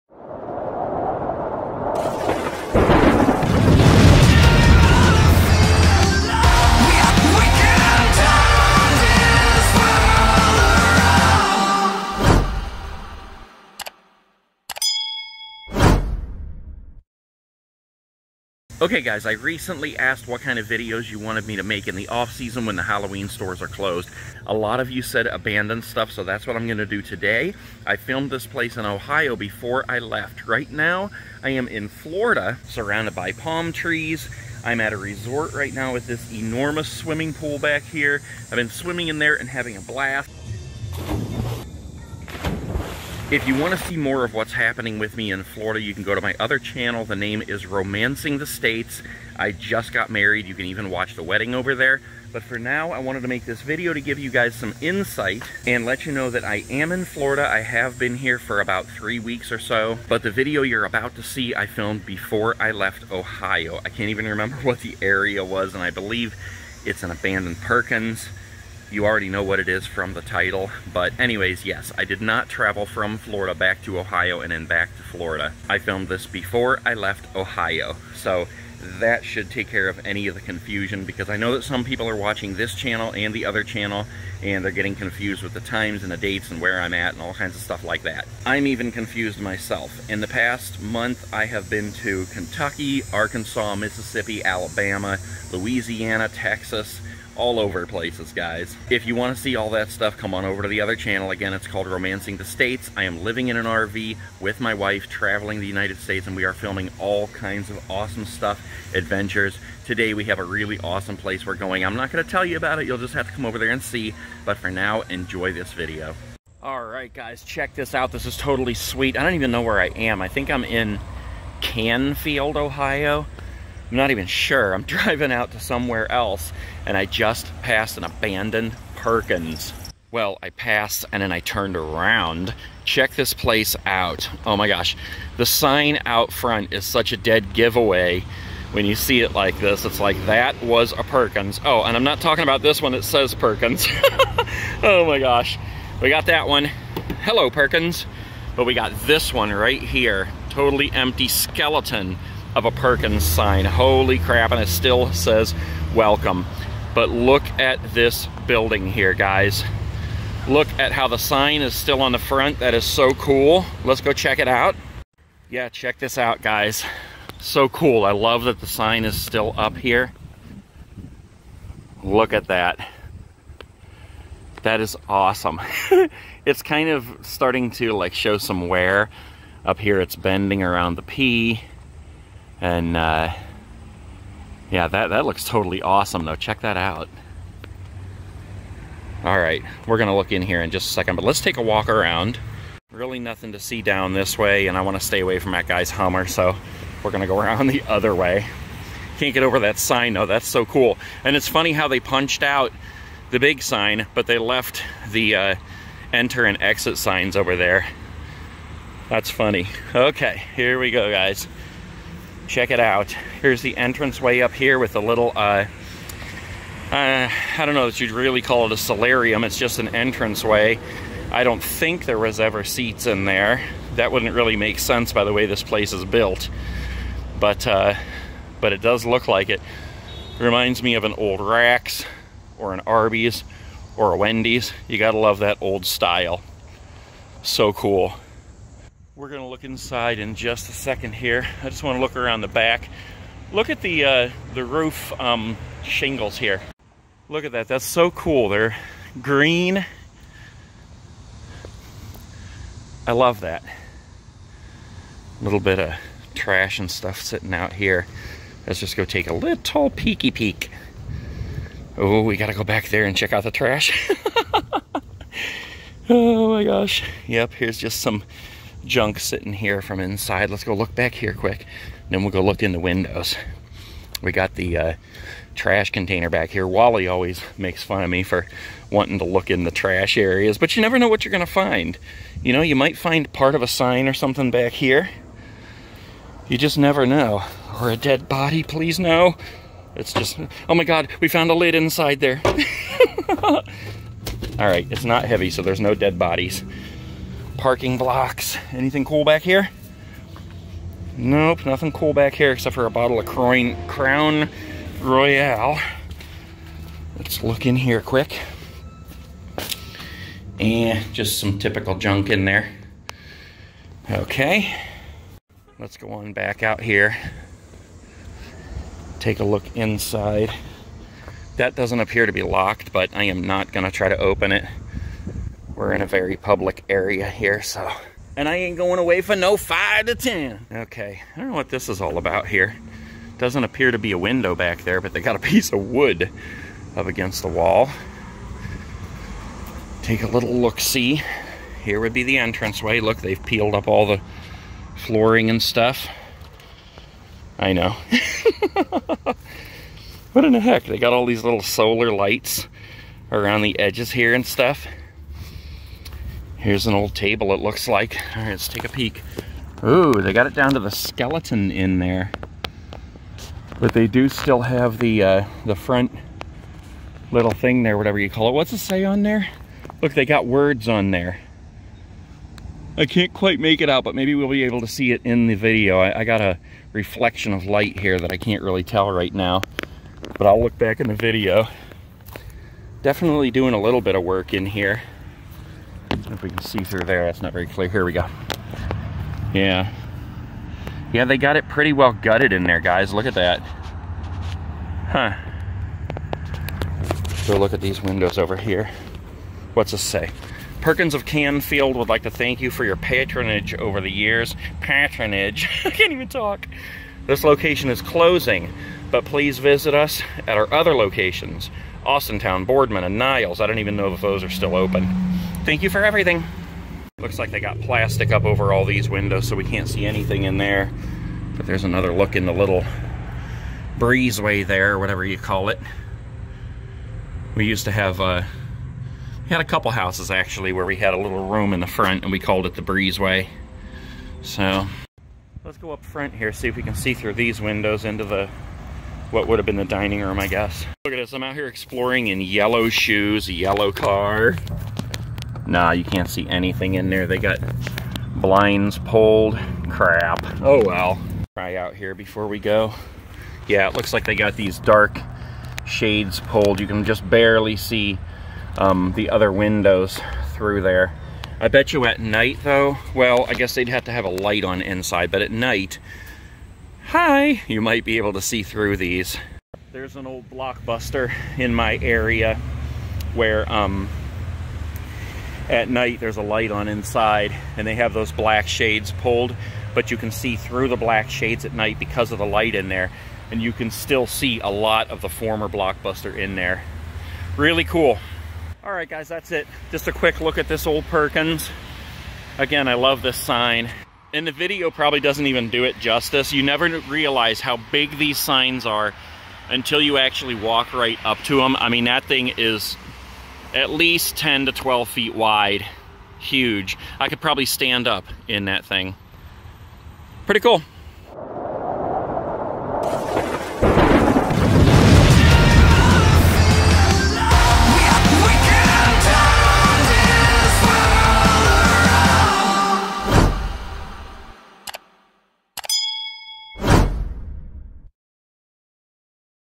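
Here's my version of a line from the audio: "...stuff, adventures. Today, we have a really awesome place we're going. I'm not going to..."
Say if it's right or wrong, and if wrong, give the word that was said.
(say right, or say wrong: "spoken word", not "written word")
right.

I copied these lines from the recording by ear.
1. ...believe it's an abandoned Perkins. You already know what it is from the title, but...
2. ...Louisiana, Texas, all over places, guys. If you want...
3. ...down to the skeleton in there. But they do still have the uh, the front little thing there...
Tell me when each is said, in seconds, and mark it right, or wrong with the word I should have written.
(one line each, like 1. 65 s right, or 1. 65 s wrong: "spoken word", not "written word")
1. 65 s right
2. 95 s right
3. 360 s right.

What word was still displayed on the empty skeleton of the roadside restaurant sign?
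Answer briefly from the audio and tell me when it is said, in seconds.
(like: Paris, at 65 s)
welcome, at 154 s.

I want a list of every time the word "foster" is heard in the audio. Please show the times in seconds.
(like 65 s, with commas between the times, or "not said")
not said.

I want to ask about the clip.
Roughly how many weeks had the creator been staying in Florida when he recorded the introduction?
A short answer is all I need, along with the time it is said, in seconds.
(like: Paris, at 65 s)
3, at 58 s.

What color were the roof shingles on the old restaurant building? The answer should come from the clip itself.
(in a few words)
Green.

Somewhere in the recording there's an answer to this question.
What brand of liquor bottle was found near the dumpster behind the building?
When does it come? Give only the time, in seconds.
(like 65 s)
303 s.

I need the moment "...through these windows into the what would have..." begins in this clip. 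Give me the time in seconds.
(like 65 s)
437 s.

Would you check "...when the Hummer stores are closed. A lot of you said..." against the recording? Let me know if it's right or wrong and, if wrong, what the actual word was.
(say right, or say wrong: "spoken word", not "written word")
wrong: "Halloween", not "Hummer".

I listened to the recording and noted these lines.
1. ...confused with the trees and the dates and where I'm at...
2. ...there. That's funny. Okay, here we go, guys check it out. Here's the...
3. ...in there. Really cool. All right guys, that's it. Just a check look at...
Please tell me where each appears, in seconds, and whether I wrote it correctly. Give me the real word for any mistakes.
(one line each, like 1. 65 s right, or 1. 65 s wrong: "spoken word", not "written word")
1. 84 s wrong: "times", not "trees"
2. 207 s right
3. 486 s wrong: "quick", not "check".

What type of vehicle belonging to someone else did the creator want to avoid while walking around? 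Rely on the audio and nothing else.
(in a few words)
Hummer.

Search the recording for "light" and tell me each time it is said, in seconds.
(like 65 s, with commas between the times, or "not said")
352 s, 377 s, 464 s, 476 s, 482 s.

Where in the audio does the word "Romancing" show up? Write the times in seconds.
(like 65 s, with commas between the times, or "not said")
47 s, 101 s.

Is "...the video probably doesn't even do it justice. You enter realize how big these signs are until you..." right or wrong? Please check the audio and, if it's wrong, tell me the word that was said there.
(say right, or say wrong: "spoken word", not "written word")
wrong: "never", not "enter".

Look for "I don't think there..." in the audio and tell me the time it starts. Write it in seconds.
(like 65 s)
221 s.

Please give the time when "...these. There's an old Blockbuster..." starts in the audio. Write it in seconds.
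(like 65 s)
468 s.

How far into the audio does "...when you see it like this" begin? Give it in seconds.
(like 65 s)
138 s.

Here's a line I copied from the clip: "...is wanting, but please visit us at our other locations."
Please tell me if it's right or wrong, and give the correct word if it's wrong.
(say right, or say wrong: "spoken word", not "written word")
wrong: "closing", not "wanting".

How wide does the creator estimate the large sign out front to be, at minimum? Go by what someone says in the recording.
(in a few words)
10 to 12 feet.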